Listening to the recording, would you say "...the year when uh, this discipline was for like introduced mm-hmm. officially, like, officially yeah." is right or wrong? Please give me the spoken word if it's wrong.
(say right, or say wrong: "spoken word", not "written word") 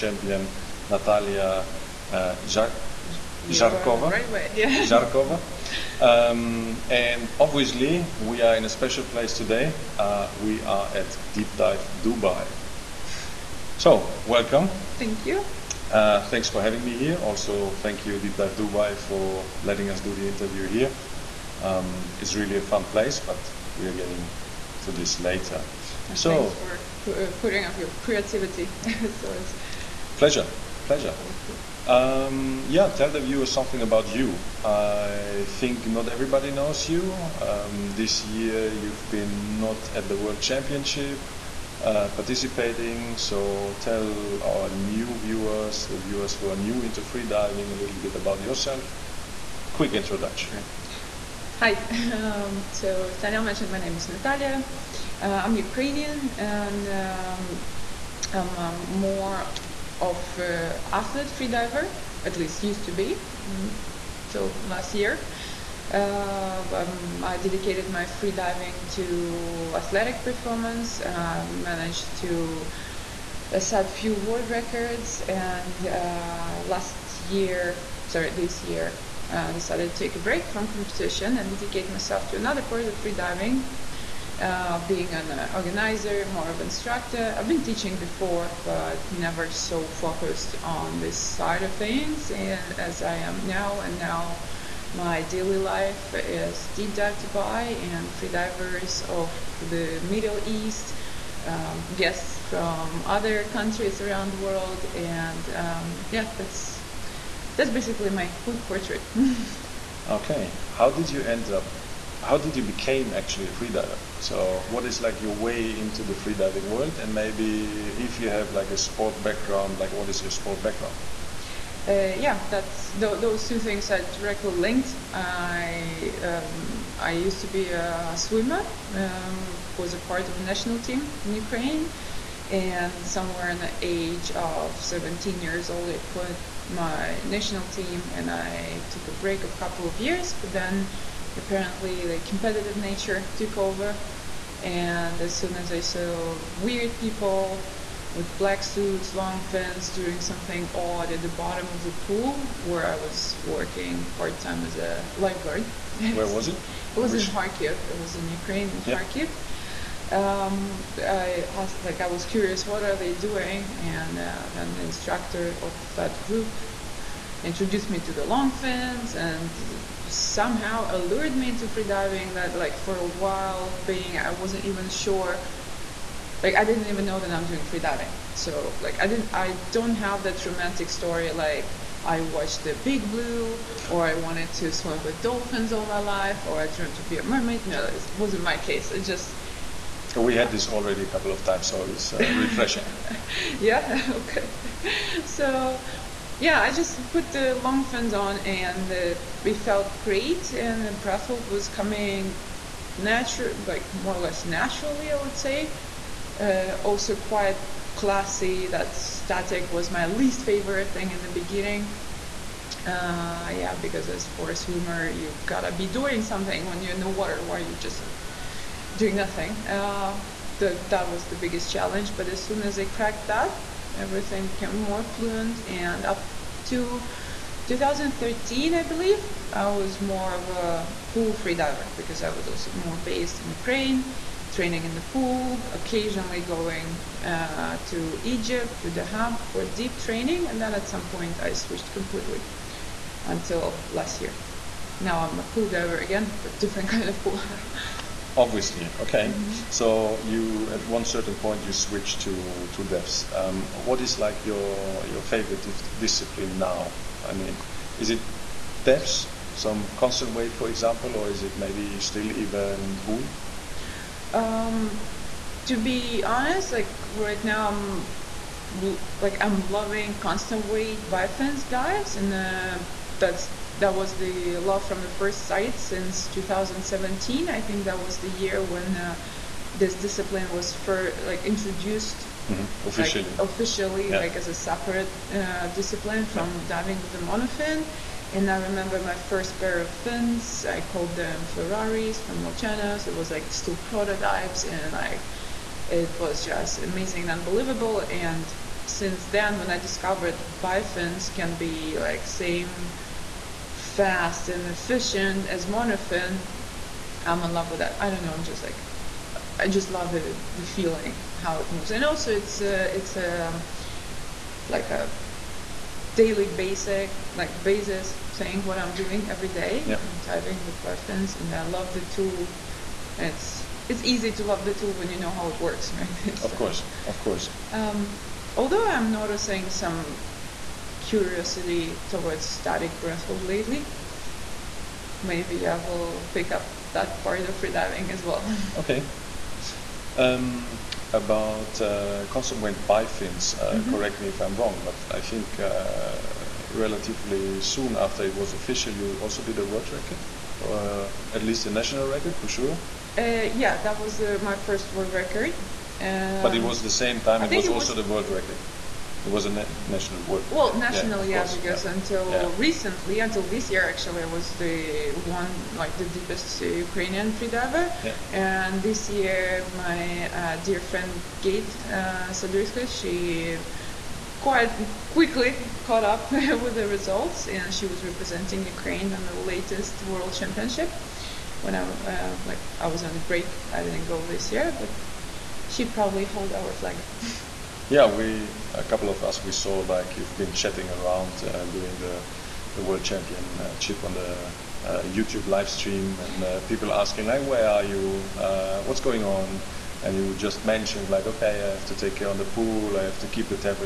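right.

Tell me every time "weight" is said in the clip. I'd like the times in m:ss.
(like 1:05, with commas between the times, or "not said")
4:20, 4:30.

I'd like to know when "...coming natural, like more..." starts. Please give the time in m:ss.
3:21.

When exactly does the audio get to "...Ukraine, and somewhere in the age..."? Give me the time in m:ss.
2:11.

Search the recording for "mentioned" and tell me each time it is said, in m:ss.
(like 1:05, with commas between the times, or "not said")
0:53, 6:40.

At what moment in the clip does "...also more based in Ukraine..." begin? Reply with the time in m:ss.
3:52.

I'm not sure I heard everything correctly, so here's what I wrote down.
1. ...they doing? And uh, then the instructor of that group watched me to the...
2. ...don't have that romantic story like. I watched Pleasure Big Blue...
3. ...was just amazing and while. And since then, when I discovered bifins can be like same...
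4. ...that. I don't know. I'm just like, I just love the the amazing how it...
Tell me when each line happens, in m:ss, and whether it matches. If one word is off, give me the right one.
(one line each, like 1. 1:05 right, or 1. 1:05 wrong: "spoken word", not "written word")
1. 2:42 wrong: "introduced", not "watched"
2. 2:59 wrong: "The", not "Pleasure"
3. 4:56 wrong: "unbelievable", not "while"
4. 5:07 wrong: "feeling", not "amazing".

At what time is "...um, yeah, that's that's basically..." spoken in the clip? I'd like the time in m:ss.
1:45.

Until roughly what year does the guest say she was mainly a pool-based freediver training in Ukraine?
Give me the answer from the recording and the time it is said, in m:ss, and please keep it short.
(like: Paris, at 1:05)
2013, at 3:47.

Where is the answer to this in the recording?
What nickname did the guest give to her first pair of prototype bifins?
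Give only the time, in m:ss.
4:51.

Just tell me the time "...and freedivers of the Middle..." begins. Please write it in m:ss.
1:37.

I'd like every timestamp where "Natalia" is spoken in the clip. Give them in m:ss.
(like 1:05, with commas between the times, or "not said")
0:00, 0:54.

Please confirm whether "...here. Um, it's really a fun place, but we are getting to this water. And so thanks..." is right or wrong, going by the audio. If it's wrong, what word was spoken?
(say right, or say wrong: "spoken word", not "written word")
wrong: "later", not "water".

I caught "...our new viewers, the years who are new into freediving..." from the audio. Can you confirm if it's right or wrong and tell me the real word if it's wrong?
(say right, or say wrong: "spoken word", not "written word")
wrong: "viewers", not "years".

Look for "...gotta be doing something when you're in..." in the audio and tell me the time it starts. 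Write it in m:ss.
3:35.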